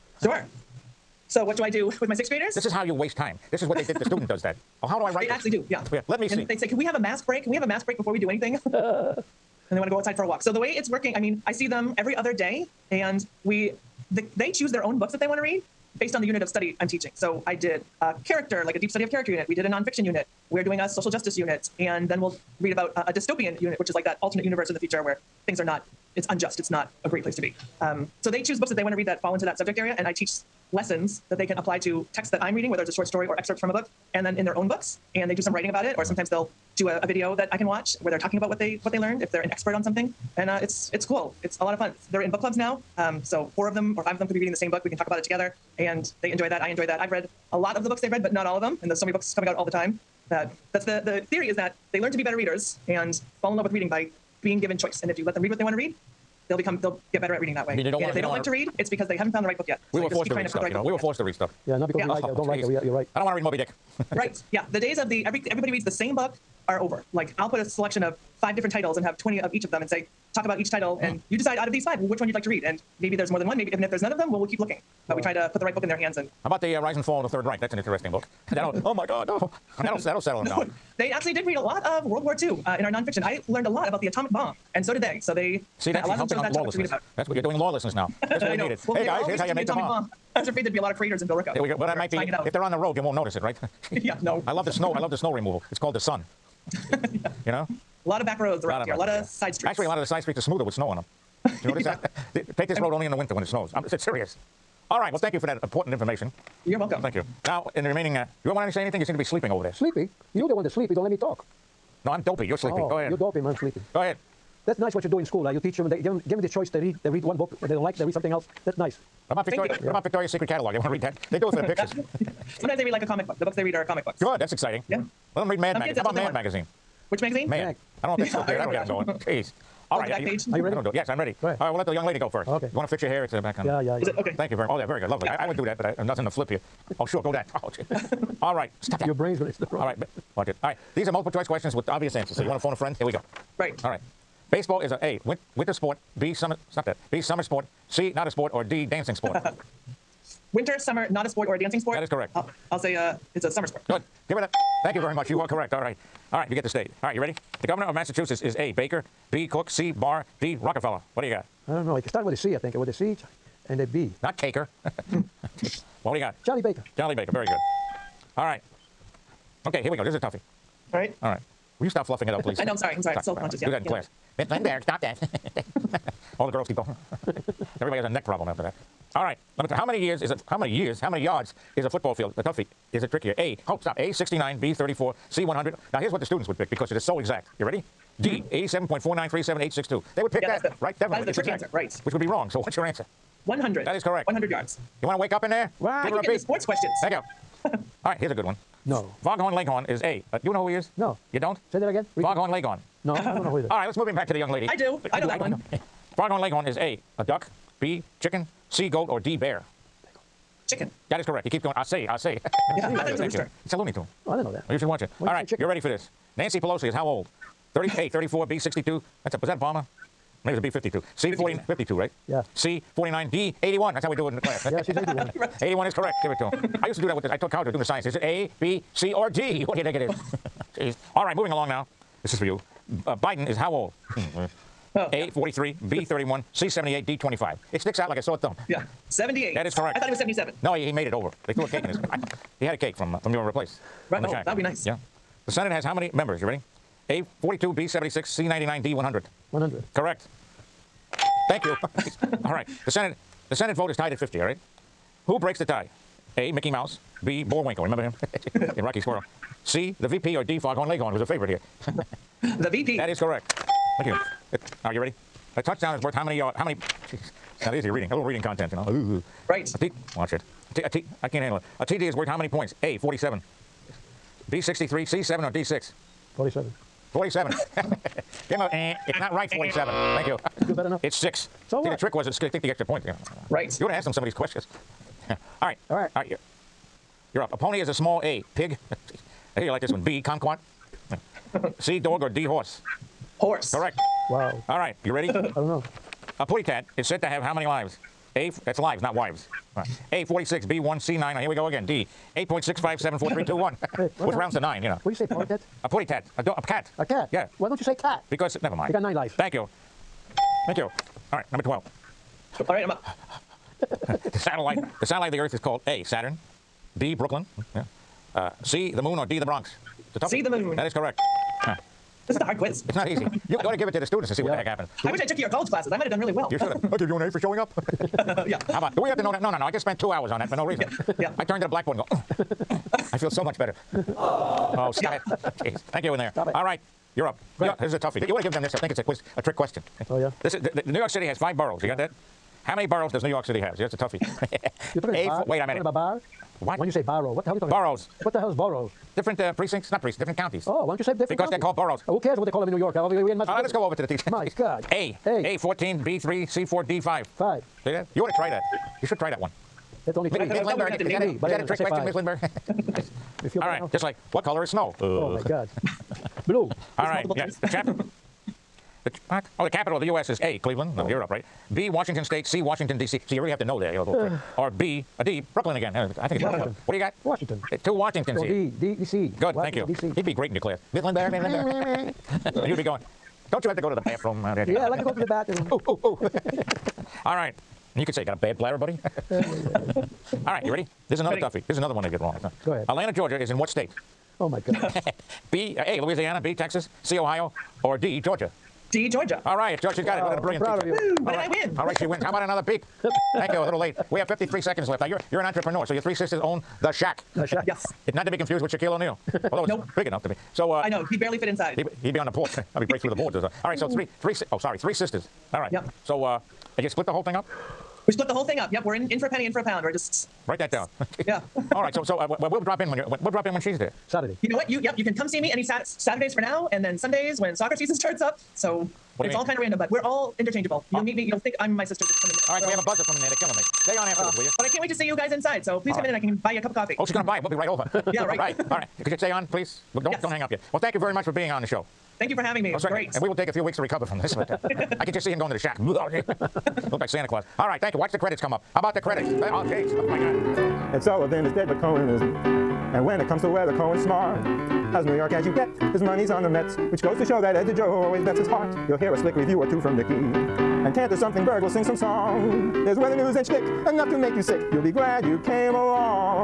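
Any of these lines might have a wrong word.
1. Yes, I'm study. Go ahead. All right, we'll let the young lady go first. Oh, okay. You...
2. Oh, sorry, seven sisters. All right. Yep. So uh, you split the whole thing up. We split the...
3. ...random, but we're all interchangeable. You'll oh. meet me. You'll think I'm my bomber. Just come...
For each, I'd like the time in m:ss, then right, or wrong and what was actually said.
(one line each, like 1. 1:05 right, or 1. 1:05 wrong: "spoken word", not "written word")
1. 2:10 wrong: "ready", not "study"
2. 6:54 wrong: "three", not "seven"
3. 7:09 wrong: "sister", not "bomber".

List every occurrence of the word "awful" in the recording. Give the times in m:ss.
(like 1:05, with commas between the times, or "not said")
not said.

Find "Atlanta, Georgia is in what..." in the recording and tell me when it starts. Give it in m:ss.
6:32.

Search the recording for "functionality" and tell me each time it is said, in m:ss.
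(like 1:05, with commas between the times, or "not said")
not said.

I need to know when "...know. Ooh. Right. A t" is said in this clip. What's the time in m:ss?
4:28.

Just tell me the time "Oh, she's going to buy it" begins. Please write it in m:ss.
7:16.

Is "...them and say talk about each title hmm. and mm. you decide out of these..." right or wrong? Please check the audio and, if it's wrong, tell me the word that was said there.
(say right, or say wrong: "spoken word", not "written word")
right.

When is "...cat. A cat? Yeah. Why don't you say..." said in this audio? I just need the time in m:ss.
5:06.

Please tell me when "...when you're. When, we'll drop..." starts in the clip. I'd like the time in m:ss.
7:02.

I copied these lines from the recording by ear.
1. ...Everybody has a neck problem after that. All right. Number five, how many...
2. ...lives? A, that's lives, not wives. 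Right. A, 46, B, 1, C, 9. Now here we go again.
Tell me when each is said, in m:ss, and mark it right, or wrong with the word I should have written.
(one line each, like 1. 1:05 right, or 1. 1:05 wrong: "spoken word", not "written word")
1. 2:57 wrong: "two", not "five"
2. 4:57 right.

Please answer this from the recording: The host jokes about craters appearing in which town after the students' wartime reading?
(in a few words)
Billerica.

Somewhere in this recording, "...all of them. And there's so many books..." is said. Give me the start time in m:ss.
0:48.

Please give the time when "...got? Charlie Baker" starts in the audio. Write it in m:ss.
2:46.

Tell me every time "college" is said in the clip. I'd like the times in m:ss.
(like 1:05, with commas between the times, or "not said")
3:47, 5:25.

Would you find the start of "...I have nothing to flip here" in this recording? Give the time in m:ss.
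2:15.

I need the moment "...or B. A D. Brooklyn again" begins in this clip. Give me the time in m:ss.
6:14.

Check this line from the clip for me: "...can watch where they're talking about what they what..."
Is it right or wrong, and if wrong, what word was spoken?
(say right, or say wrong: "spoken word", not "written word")
right.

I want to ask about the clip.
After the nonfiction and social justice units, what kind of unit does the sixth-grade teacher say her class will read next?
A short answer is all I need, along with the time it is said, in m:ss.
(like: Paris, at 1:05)
Dystopian, at 0:23.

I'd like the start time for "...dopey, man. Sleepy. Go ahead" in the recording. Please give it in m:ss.
1:53.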